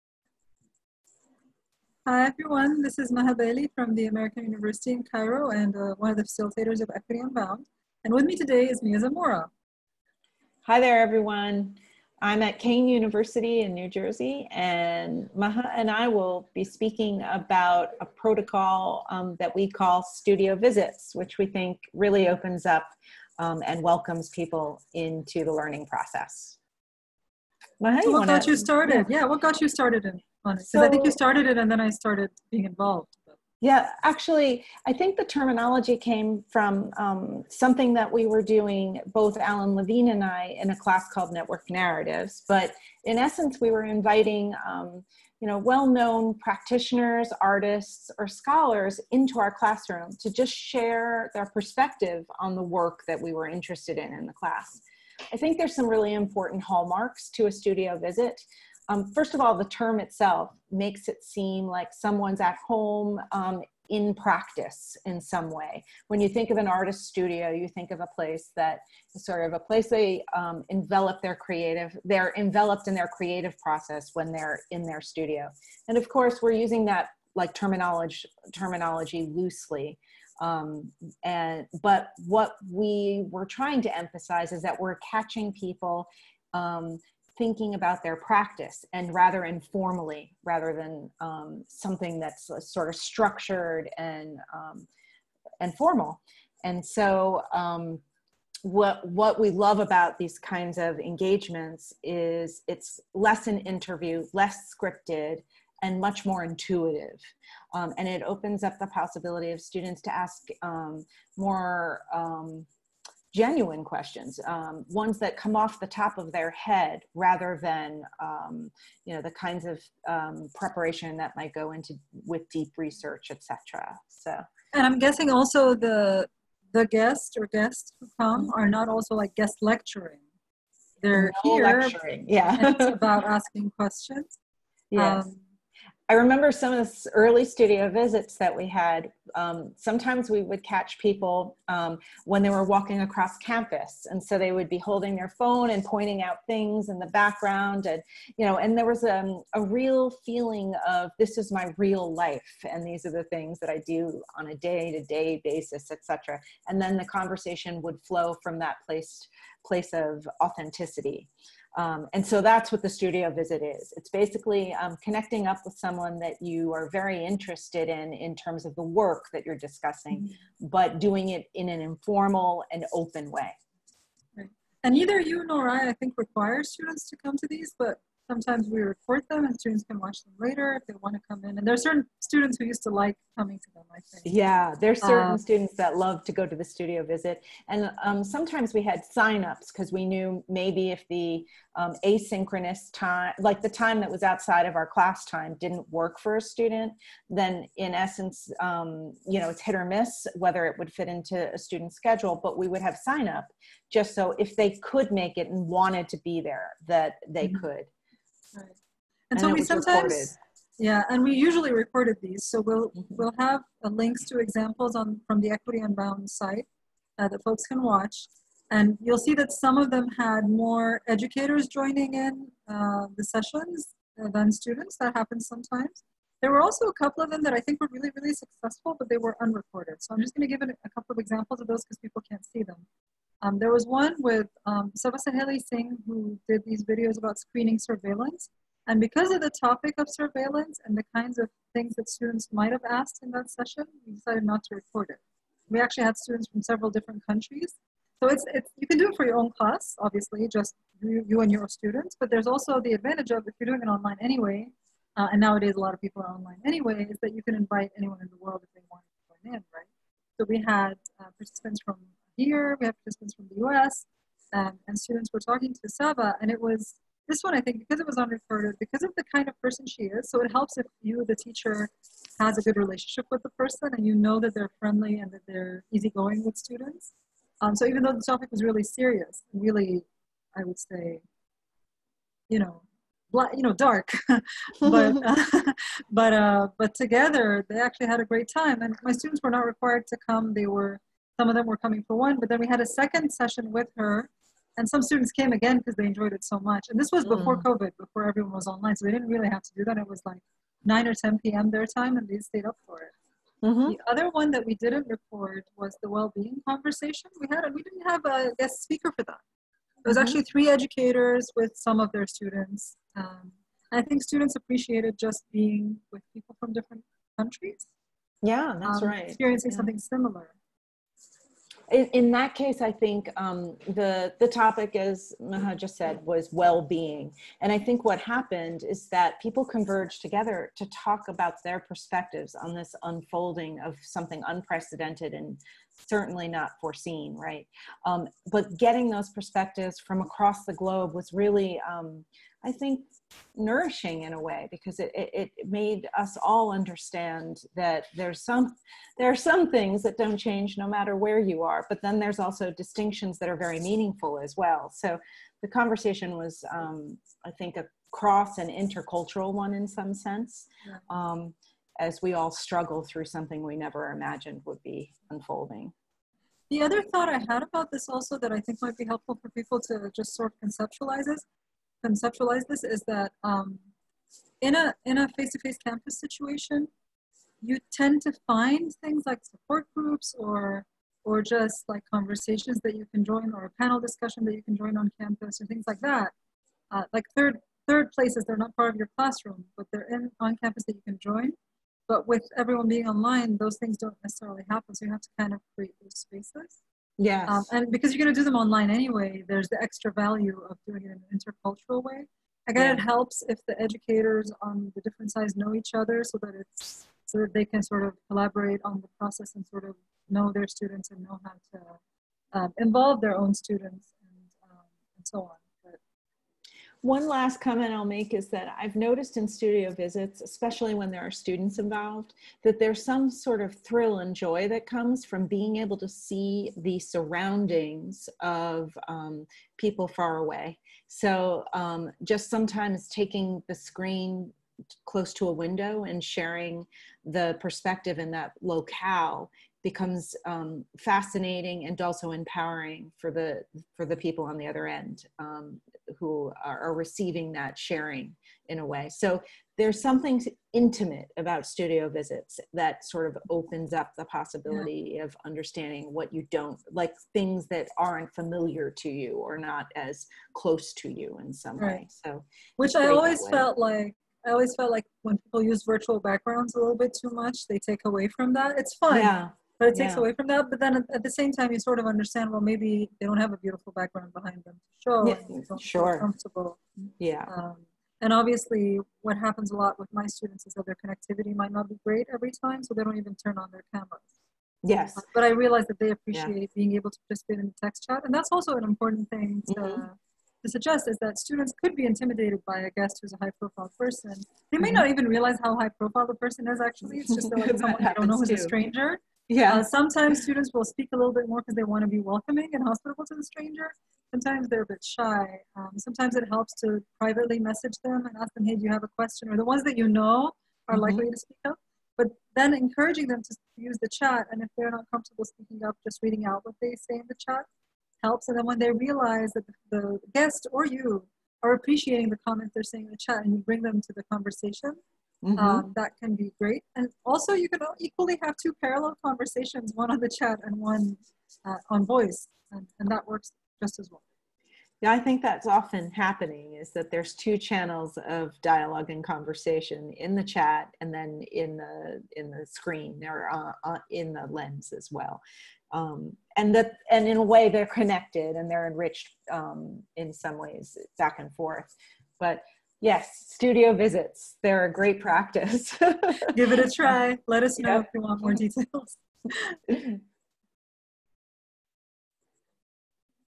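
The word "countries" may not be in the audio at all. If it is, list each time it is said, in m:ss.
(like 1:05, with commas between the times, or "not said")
4:07, 5:17.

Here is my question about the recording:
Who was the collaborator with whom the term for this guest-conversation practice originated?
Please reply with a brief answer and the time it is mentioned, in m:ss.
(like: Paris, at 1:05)
Alan Levine, at 0:39.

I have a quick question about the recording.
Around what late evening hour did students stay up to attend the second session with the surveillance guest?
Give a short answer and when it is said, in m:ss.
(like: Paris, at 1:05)
9 or 10 p.m., at 5:00.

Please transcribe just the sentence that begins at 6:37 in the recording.
Um, and because you're going to do them online anyway, there's the extra value of doing it in an intercultural way.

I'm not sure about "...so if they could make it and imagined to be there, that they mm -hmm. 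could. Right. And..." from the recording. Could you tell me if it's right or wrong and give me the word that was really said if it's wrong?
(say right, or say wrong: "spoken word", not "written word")
wrong: "wanted", not "imagined".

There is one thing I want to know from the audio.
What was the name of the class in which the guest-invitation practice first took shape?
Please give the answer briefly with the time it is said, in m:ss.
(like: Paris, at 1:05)
Network Narratives, at 0:41.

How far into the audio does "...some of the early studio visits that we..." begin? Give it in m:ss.
2:16.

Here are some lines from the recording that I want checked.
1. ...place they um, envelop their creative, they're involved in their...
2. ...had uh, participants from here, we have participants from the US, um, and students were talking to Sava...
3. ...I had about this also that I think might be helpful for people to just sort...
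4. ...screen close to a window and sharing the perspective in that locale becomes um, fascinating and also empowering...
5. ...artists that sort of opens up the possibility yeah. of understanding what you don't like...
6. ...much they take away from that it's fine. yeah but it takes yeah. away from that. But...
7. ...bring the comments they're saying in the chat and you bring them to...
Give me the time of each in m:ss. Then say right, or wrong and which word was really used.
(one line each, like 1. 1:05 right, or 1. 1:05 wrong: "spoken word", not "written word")
1. 1:09 wrong: "enveloped", not "involved"
2. 4:20 right
3. 6:07 right
4. 7:13 right
5. 7:32 wrong: "visits", not "artists"
6. 7:47 right
7. 8:41 wrong: "appreciating", not "bring".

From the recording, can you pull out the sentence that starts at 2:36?
And then the conversation would flow from that place place of authenticity.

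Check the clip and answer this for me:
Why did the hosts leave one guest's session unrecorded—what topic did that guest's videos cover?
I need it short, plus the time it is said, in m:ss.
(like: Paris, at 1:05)
screening surveillance, at 3:57.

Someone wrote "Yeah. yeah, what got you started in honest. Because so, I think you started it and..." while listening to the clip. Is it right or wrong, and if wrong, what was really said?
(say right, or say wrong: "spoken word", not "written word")
right.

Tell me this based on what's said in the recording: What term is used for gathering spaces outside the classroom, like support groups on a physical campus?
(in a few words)
third places.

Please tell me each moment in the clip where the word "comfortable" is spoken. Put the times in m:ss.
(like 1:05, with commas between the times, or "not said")
7:56, 8:35.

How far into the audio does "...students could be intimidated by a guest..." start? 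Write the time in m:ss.
8:11.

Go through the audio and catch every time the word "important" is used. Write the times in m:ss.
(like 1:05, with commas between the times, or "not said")
0:56, 8:08.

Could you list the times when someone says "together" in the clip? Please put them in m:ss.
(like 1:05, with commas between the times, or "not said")
4:46, 5:30.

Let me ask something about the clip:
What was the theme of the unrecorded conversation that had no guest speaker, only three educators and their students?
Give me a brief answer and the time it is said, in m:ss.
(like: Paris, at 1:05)
well-being, at 5:06.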